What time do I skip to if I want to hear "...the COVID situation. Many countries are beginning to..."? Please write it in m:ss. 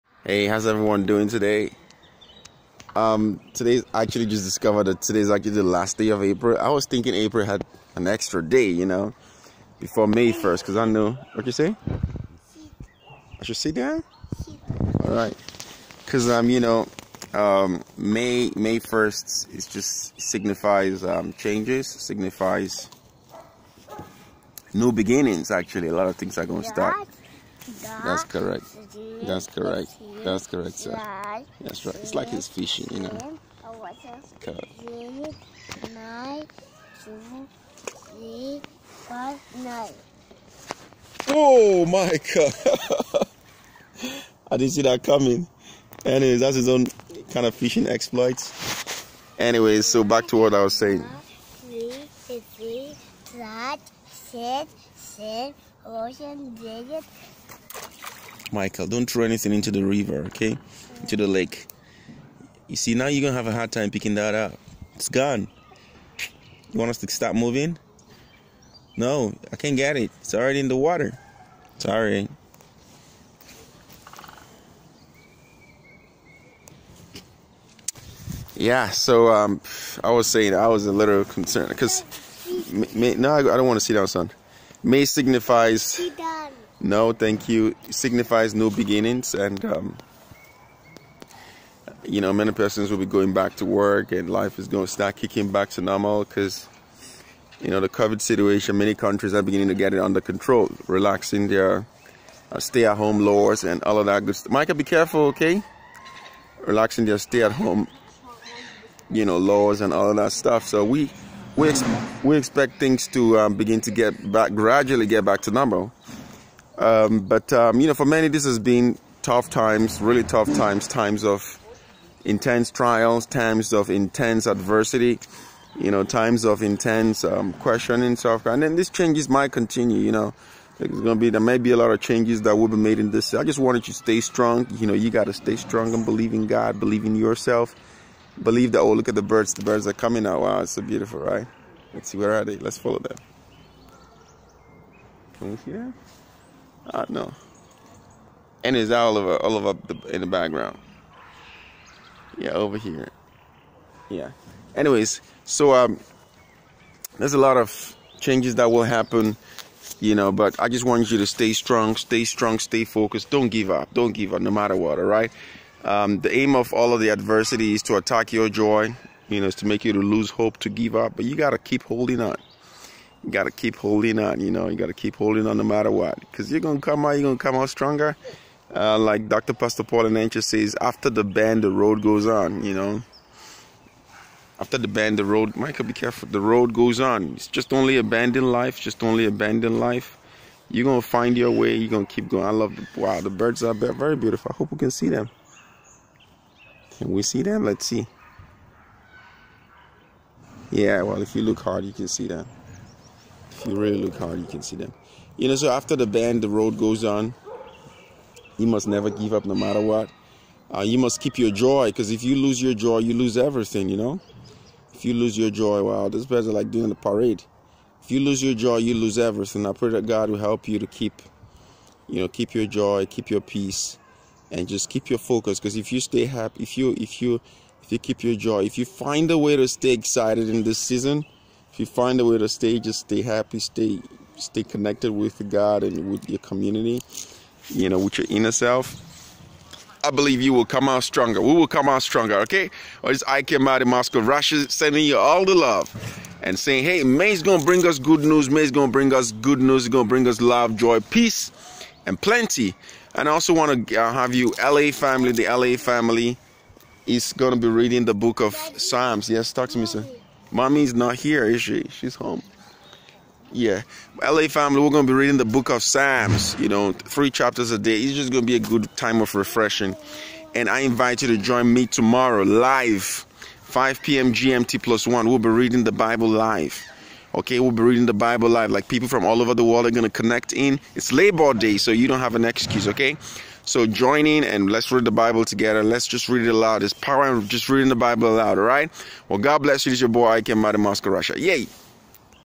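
1:37.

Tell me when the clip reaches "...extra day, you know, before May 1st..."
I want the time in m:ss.
0:08.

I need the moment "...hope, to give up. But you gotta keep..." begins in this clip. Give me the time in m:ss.
2:50.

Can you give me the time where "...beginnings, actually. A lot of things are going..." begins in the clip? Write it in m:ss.
0:24.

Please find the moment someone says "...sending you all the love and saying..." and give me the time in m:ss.
4:04.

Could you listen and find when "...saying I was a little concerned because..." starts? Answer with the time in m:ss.
1:20.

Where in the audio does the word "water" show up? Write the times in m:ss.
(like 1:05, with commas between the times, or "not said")
1:10.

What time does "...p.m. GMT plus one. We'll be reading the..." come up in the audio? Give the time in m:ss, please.
4:34.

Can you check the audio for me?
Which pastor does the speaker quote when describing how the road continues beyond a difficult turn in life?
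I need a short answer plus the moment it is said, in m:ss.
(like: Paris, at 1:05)
Paul Enenche, at 2:59.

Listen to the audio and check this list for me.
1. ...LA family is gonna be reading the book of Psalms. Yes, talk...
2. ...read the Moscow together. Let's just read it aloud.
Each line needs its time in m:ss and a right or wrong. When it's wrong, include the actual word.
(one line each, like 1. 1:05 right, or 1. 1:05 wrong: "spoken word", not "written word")
1. 4:15 right
2. 4:44 wrong: "Bible", not "Moscow".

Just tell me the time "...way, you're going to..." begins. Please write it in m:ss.
3:11.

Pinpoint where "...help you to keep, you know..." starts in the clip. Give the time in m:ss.
3:40.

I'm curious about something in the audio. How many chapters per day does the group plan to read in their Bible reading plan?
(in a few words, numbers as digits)
3.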